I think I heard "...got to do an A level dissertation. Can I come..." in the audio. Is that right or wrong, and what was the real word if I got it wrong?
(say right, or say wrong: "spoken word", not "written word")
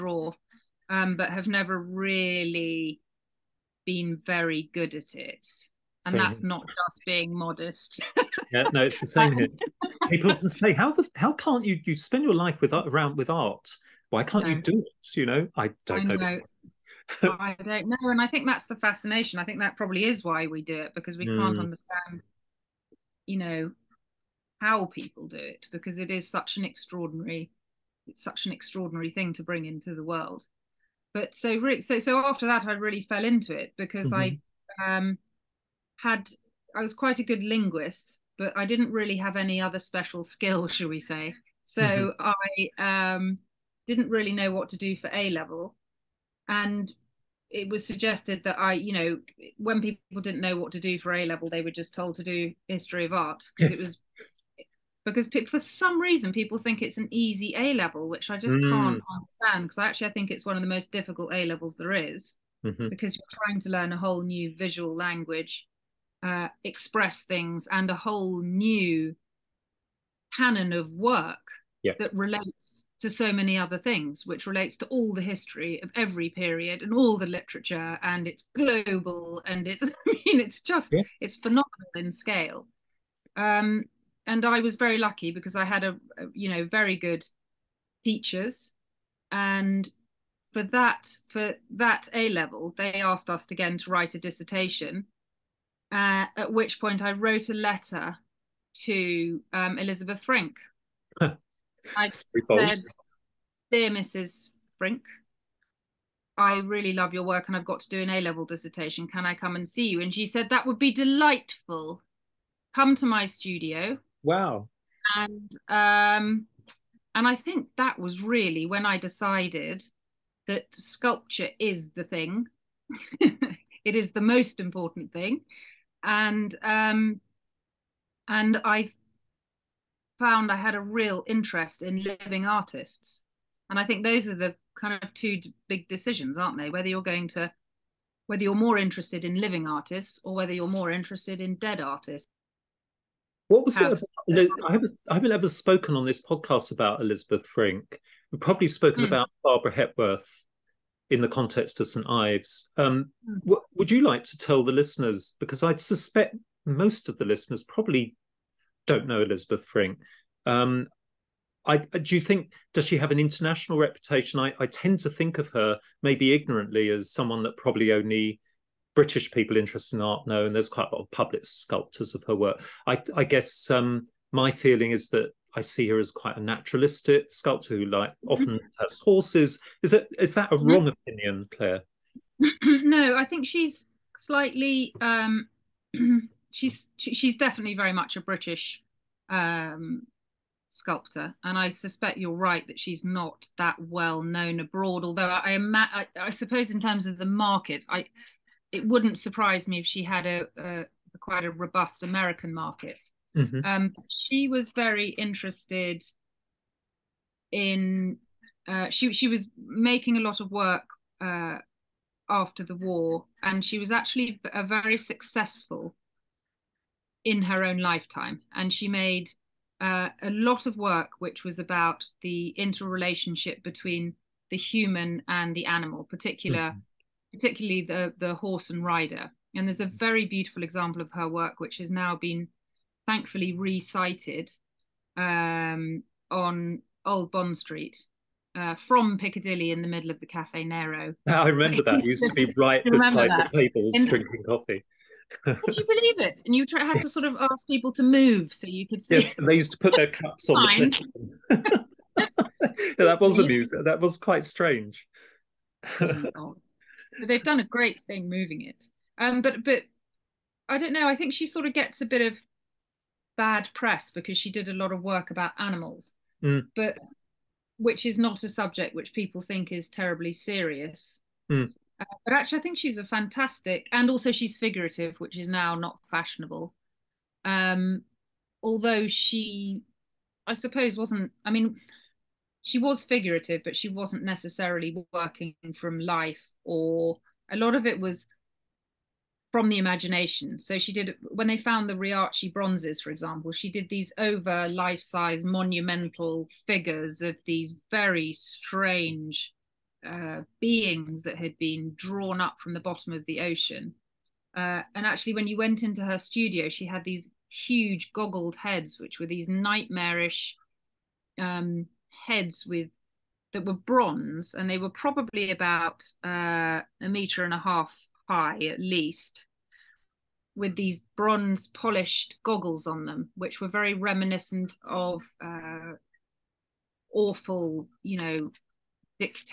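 right.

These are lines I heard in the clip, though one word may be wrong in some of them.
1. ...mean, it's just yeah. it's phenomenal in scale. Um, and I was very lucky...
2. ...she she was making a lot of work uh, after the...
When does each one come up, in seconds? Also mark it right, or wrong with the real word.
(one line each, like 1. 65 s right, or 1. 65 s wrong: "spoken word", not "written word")
1. 80 s right
2. 208 s right.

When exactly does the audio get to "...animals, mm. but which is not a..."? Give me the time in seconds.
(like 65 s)
265 s.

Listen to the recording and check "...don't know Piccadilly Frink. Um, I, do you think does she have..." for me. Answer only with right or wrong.
wrong.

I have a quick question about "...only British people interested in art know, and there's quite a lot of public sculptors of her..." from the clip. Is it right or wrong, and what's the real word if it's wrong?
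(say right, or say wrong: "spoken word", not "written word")
right.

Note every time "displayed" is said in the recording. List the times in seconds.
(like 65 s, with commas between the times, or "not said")
not said.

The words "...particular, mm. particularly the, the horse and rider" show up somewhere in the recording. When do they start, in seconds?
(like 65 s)
226 s.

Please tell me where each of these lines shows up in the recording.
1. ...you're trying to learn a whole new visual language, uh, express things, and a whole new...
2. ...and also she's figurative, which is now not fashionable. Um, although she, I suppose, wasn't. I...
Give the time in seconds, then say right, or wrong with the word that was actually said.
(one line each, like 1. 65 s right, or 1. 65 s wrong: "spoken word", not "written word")
1. 63 s right
2. 273 s right.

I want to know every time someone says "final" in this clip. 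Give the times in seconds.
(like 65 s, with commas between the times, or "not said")
not said.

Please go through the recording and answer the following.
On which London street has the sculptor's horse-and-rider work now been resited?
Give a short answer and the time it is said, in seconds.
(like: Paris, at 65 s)
Old Bond Street, at 237 s.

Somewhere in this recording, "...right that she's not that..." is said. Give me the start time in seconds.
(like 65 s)
192 s.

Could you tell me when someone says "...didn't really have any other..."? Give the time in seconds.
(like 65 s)
38 s.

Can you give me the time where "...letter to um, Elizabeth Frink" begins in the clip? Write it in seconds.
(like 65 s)
97 s.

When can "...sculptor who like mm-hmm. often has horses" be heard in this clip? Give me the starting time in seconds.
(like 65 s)
177 s.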